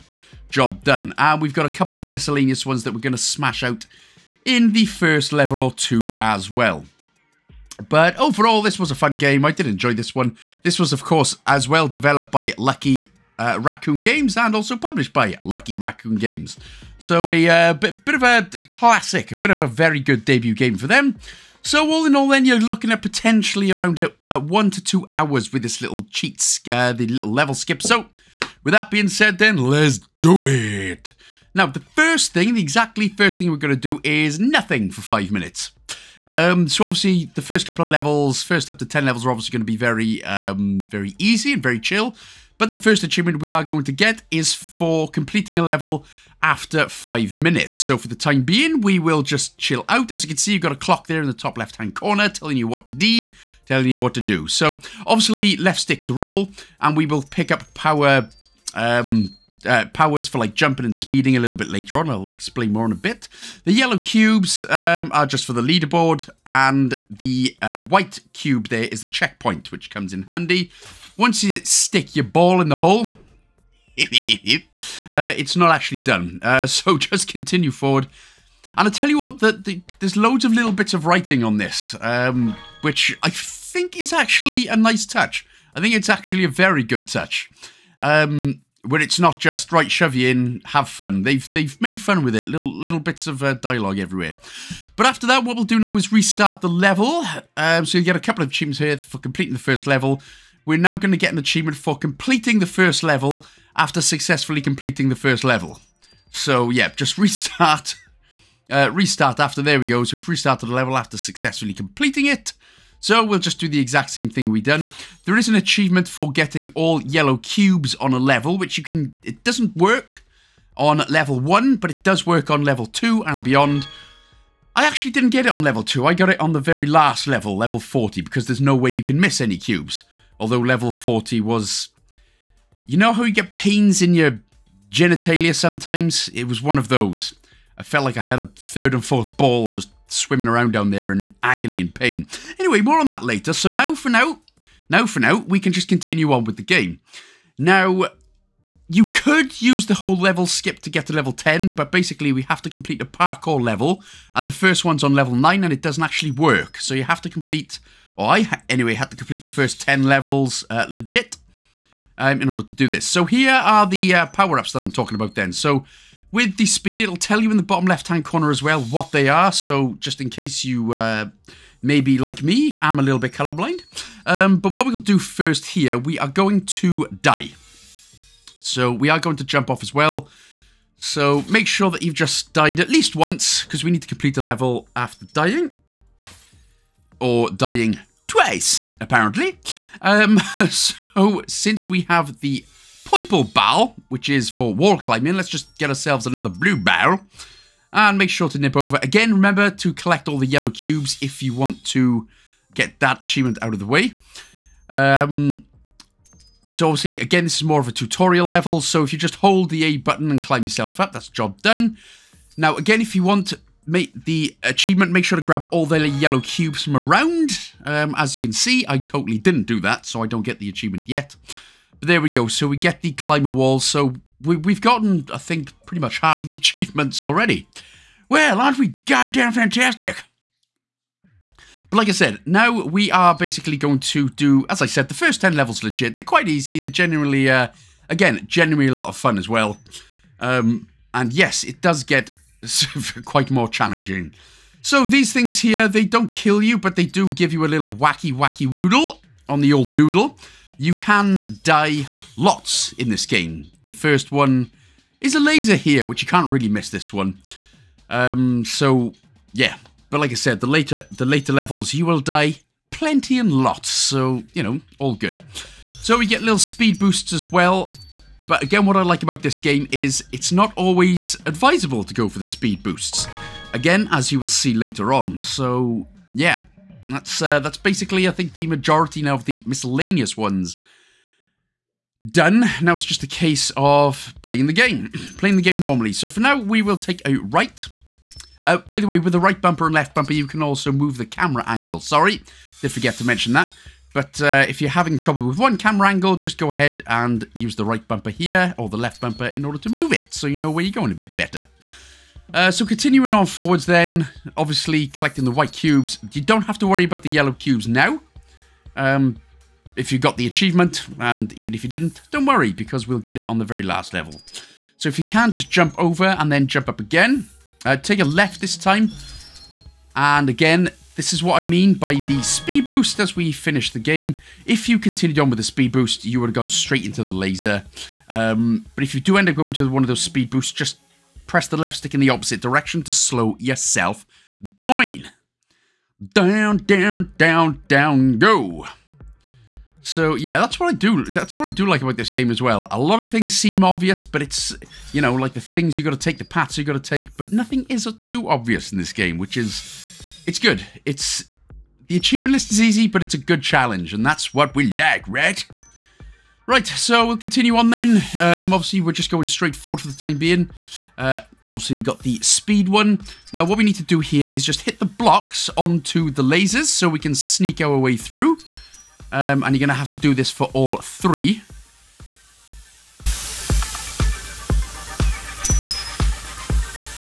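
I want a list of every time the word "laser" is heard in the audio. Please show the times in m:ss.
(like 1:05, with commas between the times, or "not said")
4:15, 5:27, 6:06.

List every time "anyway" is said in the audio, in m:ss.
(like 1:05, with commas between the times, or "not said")
2:22, 2:38.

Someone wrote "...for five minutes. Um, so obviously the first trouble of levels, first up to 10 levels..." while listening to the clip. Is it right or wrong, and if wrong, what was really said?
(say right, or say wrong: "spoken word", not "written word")
wrong: "couple", not "trouble".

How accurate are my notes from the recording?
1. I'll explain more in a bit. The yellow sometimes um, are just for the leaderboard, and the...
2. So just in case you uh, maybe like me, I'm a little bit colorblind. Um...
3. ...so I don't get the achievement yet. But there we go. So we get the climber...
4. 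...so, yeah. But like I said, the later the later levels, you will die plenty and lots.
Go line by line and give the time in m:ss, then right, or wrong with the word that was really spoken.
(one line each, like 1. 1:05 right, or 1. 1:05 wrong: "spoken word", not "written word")
1. 1:02 wrong: "cubes", not "sometimes"
2. 2:49 right
3. 3:40 right
4. 4:18 right.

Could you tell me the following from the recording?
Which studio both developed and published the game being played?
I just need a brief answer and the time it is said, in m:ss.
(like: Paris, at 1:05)
Lucky Raccoon Games, at 0:15.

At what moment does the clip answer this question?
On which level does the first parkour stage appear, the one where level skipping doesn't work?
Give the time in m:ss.
2:35.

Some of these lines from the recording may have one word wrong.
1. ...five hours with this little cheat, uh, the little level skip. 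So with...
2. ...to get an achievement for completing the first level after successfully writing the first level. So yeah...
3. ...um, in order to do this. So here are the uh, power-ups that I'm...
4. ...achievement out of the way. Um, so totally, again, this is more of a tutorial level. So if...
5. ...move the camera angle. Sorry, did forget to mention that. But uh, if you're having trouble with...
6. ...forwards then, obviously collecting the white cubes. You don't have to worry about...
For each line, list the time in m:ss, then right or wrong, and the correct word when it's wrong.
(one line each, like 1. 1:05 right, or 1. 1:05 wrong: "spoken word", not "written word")
1. 0:24 wrong: "two", not "five"
2. 1:41 wrong: "completing", not "writing"
3. 2:42 right
4. 3:23 wrong: "obviously", not "totally"
5. 4:50 right
6. 5:03 right.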